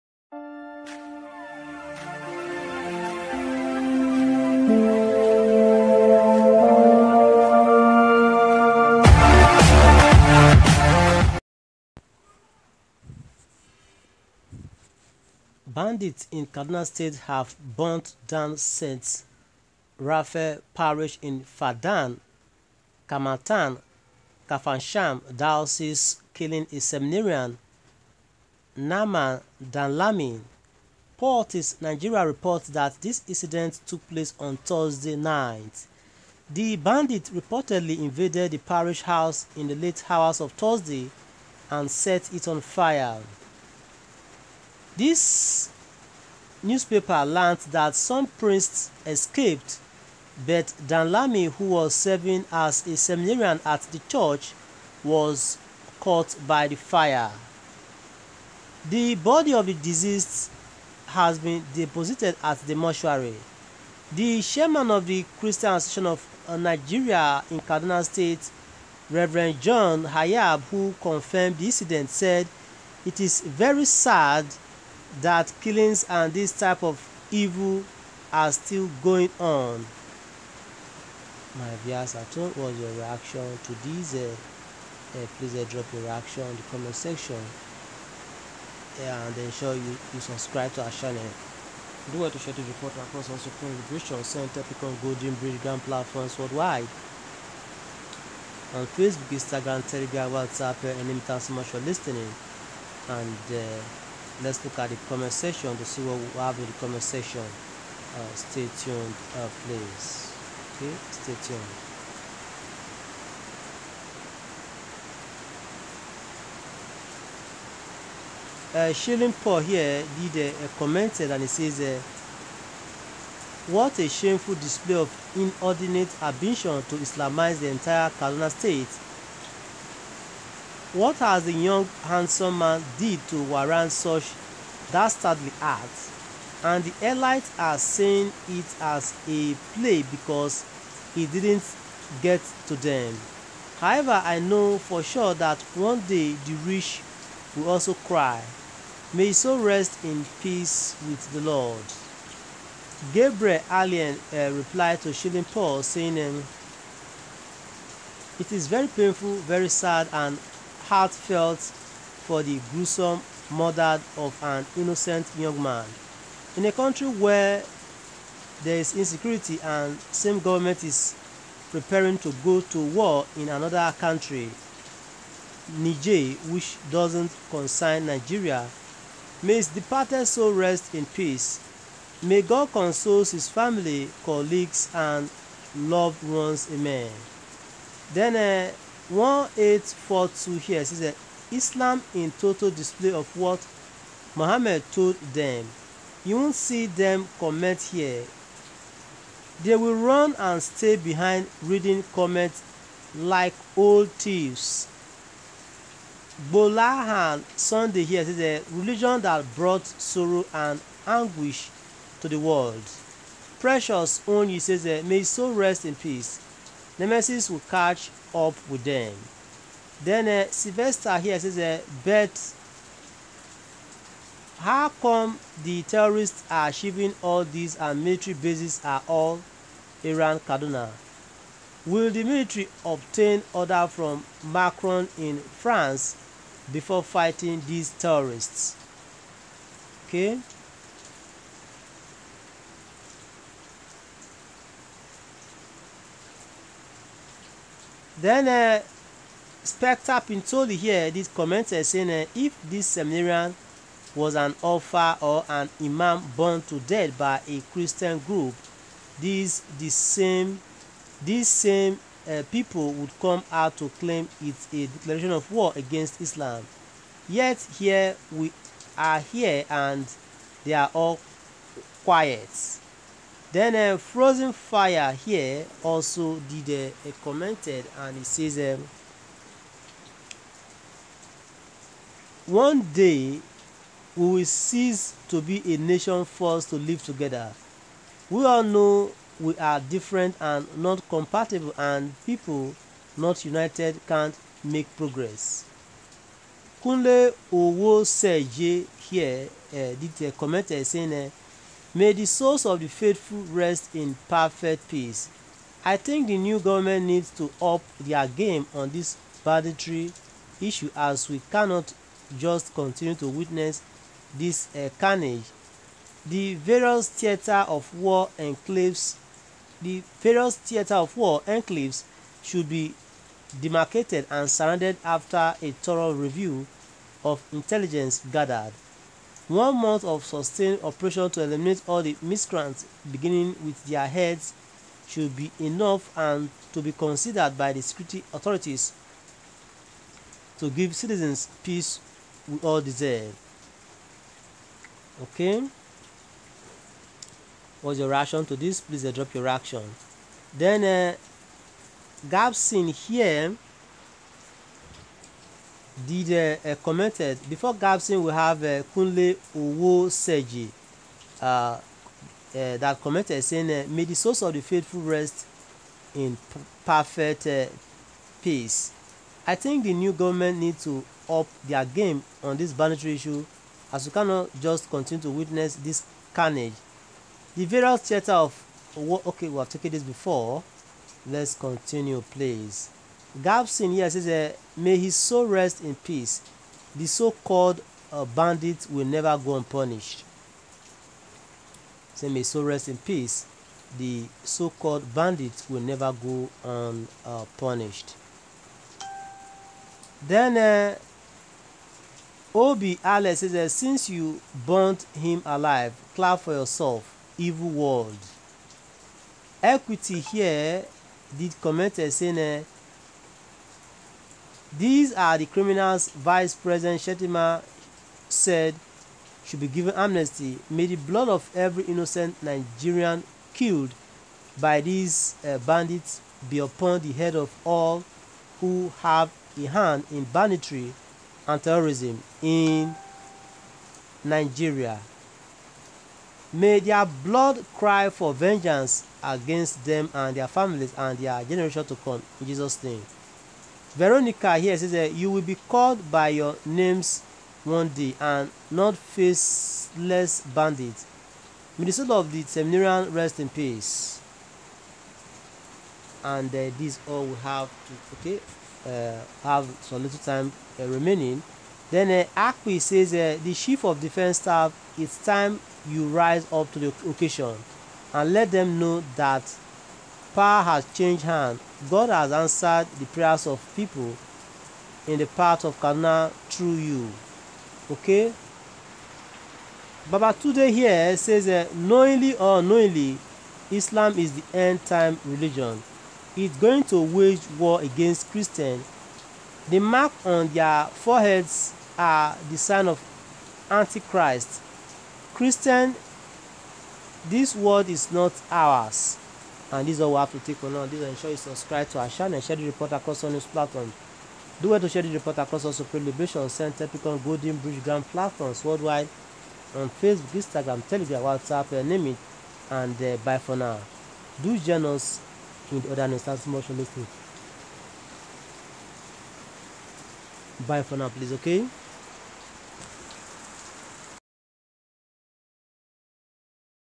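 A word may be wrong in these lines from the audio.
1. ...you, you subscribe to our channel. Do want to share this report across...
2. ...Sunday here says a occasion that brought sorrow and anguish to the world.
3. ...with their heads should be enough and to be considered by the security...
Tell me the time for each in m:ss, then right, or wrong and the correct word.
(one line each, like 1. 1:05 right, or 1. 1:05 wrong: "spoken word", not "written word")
1. 1:29 right
2. 3:27 wrong: "religion", not "occasion"
3. 5:33 right.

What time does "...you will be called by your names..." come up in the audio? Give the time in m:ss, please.
7:25.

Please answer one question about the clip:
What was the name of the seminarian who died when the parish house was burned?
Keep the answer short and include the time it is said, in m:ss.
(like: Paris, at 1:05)
Naman Danlami, at 0:28.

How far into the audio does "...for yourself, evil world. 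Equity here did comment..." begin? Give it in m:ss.
6:46.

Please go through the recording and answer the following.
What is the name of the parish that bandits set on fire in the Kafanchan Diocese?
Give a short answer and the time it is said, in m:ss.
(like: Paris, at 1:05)
St. Raphael Parish, at 0:18.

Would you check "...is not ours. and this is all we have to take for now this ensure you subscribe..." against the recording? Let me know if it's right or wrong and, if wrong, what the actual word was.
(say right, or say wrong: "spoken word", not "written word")
right.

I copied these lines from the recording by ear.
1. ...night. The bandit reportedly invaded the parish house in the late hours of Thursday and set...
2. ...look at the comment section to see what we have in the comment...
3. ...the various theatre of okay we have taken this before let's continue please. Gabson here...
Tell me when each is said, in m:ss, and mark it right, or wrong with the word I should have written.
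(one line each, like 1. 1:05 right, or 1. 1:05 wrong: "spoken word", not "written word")
1. 0:35 right
2. 1:44 right
3. 6:17 right.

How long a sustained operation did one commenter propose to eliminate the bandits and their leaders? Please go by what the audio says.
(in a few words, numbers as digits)
One month.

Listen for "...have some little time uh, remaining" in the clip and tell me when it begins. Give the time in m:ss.
7:39.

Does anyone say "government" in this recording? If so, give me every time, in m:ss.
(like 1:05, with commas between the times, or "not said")
2:50, 5:06, 6:10.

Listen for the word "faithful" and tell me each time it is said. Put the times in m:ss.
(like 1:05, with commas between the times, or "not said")
5:02, 6:04.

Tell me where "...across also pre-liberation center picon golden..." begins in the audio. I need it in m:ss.
8:25.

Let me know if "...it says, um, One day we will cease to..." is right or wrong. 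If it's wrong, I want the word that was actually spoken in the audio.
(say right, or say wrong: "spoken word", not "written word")
right.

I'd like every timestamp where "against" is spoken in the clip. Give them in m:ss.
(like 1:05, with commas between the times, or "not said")
4:25, 7:19, 8:07.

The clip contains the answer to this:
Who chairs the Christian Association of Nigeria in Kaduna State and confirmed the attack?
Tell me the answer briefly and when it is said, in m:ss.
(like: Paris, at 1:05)
John Hayab, at 1:09.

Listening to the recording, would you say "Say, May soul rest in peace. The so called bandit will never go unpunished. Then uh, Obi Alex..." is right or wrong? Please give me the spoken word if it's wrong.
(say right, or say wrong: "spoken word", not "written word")
right.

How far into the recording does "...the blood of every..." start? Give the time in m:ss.
7:00.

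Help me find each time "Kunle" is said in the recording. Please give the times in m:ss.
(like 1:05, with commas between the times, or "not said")
4:56, 5:58.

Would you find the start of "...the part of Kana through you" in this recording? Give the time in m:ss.
7:55.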